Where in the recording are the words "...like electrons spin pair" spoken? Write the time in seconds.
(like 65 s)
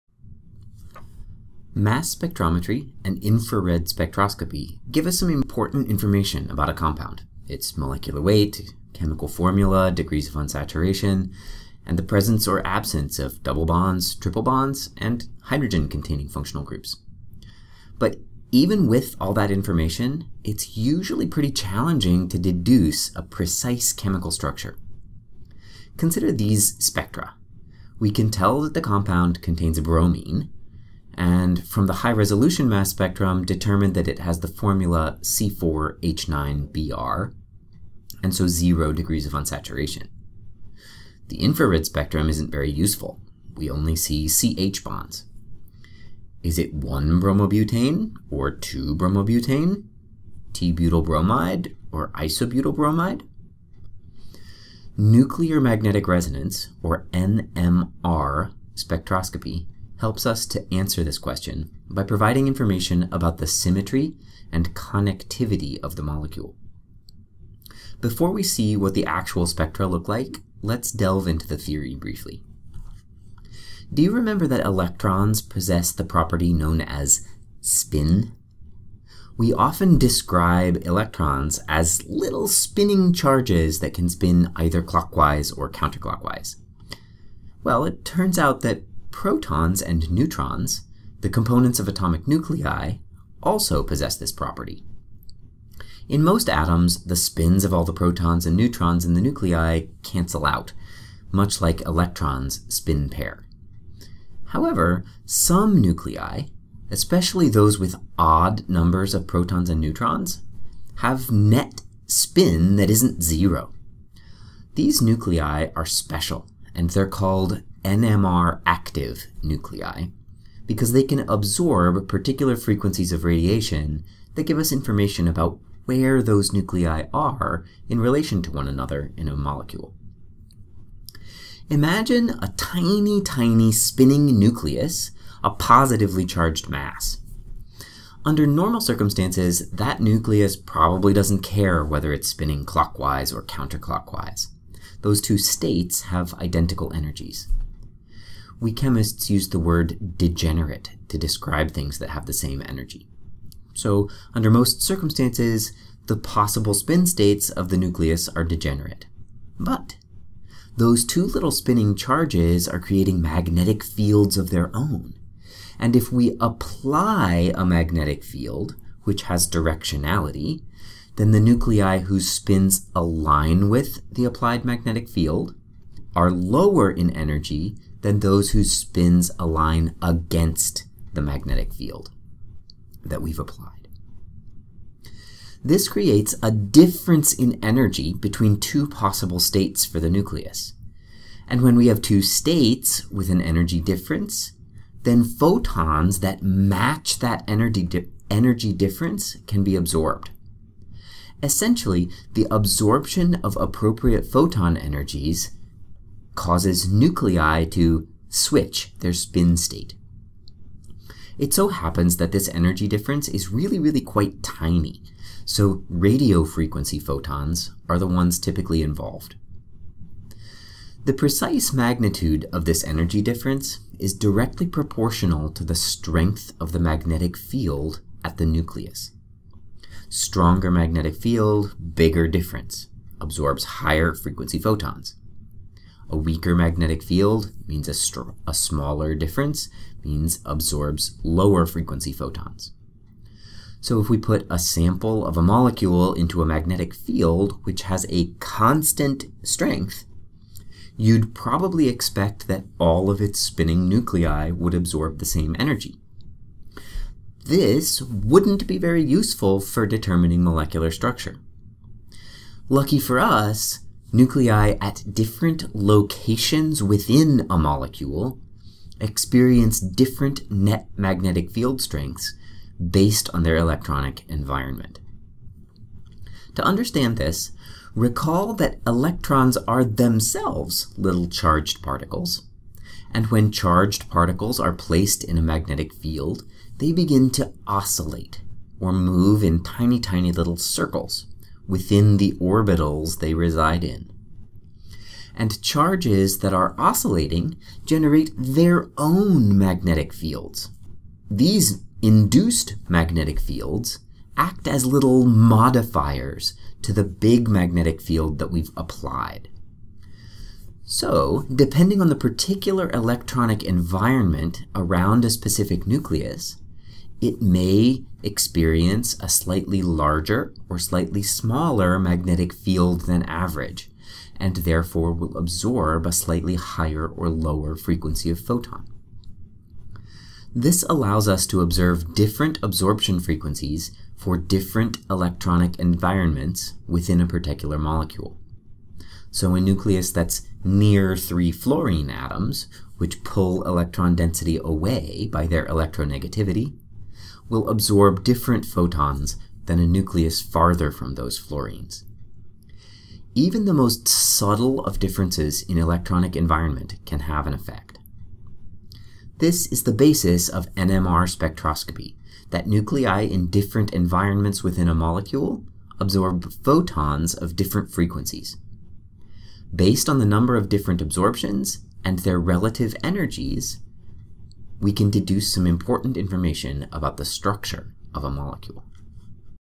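101 s.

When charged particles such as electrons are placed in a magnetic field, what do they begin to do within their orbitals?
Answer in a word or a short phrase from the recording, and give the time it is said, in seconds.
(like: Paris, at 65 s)
oscillate, at 287 s.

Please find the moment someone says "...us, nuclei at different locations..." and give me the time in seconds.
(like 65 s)
263 s.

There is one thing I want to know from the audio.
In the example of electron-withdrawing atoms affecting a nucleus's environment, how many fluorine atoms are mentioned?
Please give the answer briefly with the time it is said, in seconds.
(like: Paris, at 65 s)
3, at 341 s.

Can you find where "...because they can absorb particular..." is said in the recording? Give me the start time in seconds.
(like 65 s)
120 s.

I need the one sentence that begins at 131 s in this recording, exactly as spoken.
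Imagine a tiny, tiny spinning nucleus, a positively charged mass.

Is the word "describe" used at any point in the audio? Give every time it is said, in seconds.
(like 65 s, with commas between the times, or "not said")
79 s, 151 s.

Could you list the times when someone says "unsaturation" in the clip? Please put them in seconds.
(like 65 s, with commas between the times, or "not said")
10 s, 39 s.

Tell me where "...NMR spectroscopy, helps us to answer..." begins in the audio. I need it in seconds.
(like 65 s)
57 s.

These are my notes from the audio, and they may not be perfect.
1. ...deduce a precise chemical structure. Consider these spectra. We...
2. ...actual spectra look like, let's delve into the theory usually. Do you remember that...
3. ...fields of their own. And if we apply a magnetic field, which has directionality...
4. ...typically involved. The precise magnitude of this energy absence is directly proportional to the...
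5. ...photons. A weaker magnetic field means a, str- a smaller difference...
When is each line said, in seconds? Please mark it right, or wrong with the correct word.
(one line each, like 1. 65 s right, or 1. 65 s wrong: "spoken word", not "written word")
1. 22 s right
2. 69 s wrong: "briefly", not "usually"
3. 163 s right
4. 218 s wrong: "difference", not "absence"
5. 234 s right.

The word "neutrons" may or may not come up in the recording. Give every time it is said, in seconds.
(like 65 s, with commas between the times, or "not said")
90 s, 98 s, 109 s.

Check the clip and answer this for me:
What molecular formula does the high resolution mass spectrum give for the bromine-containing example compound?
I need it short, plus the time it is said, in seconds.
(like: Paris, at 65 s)
C4H9Br, at 35 s.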